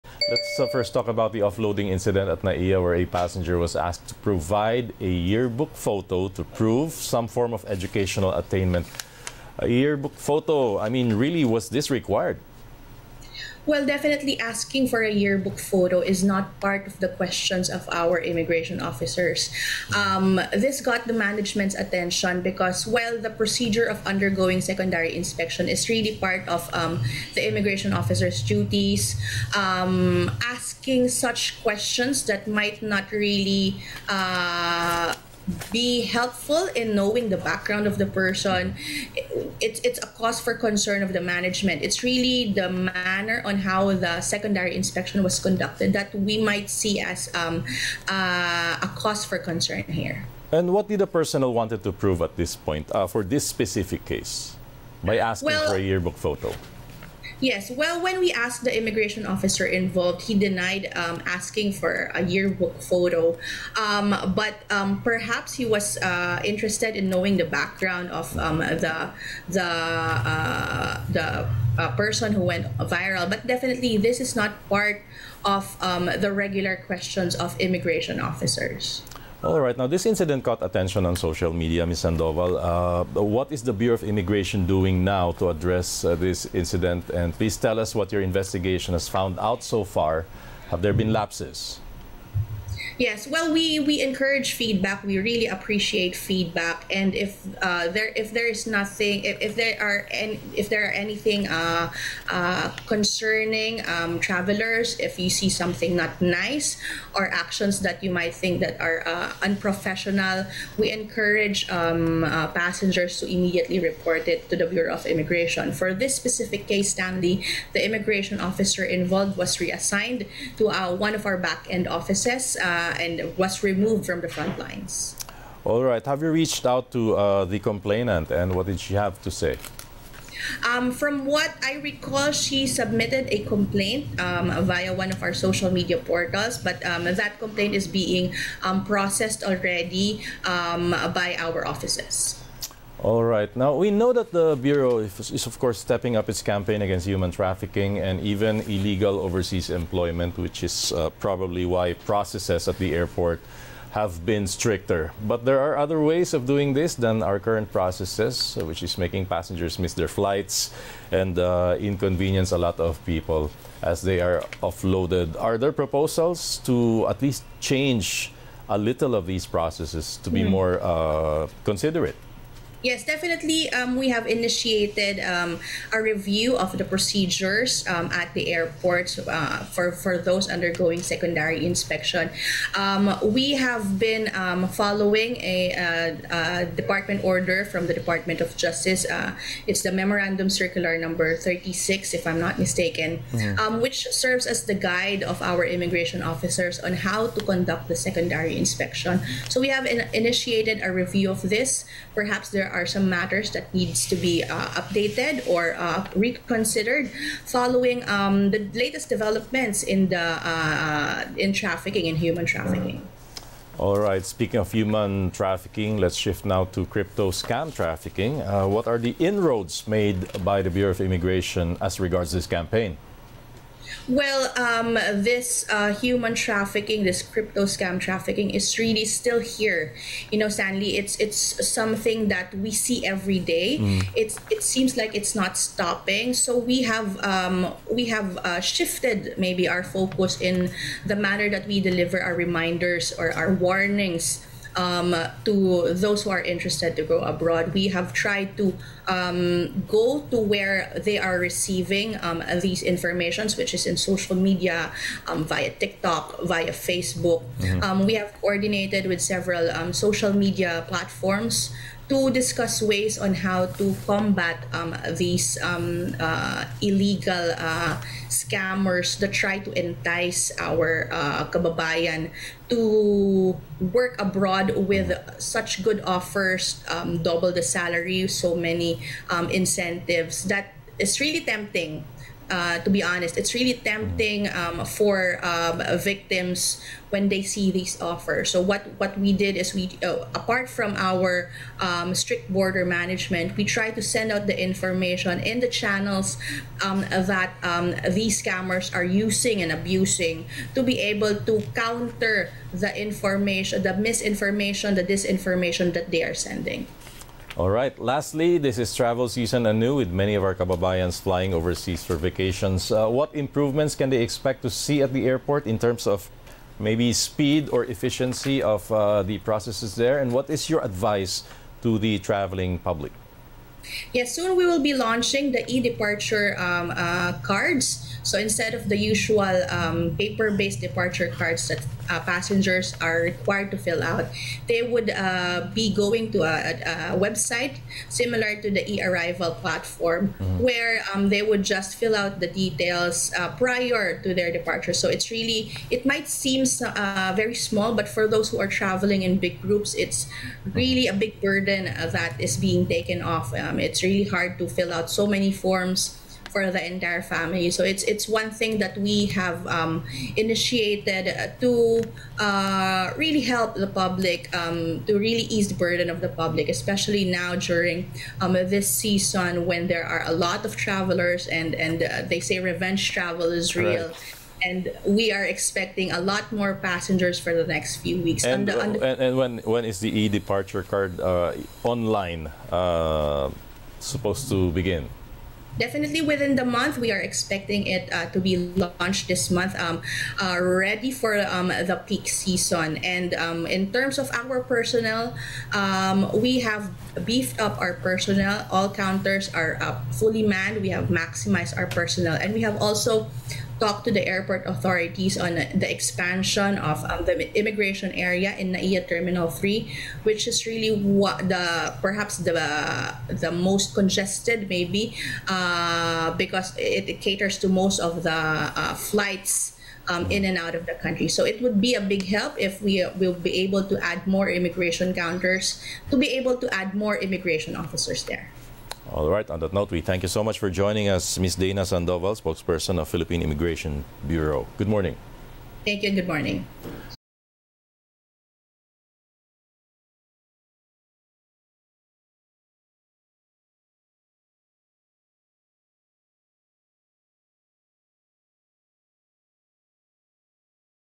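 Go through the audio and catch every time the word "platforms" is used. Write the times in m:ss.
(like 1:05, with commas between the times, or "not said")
4:20, 5:39.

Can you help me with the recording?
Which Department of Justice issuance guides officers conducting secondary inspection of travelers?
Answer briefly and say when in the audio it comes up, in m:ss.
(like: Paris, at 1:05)
Memorandum Circular 36, at 3:09.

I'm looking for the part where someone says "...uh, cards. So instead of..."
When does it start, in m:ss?
5:26.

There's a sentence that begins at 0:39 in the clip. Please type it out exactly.
It's it's a cause for concern of the management.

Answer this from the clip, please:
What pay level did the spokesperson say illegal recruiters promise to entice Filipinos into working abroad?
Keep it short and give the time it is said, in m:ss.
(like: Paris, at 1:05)
Double the salary, at 4:37.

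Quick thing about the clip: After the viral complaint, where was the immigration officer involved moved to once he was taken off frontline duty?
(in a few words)
Back end offices.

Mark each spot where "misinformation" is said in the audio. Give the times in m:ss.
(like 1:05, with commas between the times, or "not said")
5:03.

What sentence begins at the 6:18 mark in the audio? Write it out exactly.
And, the, the, and, and, when when is the e-departure card uh, online uh, supposed to begin?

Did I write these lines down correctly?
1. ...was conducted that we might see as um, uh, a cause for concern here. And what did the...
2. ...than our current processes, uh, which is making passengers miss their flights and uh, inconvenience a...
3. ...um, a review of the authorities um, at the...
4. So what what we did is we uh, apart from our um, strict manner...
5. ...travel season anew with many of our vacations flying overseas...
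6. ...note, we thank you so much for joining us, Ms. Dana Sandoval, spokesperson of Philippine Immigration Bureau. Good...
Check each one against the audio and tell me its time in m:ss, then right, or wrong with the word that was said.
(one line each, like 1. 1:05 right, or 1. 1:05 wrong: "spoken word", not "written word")
1. 0:45 right
2. 2:36 right
3. 2:55 wrong: "procedures", not "authorities"
4. 4:48 wrong: "border", not "manner"
5. 5:08 wrong: "kababayans", not "vacations"
6. 7:09 right.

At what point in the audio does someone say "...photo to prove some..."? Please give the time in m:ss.
0:05.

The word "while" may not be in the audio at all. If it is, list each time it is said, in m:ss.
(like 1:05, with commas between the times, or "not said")
0:22.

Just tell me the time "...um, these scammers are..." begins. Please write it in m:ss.
4:57.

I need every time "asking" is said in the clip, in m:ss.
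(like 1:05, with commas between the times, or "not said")
0:14, 0:30, 0:55, 1:01.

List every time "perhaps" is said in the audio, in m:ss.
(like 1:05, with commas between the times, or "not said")
1:05, 3:22, 6:51.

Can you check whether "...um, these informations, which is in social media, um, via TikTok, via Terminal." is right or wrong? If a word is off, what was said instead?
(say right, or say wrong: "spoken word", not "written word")
wrong: "Facebook", not "Terminal".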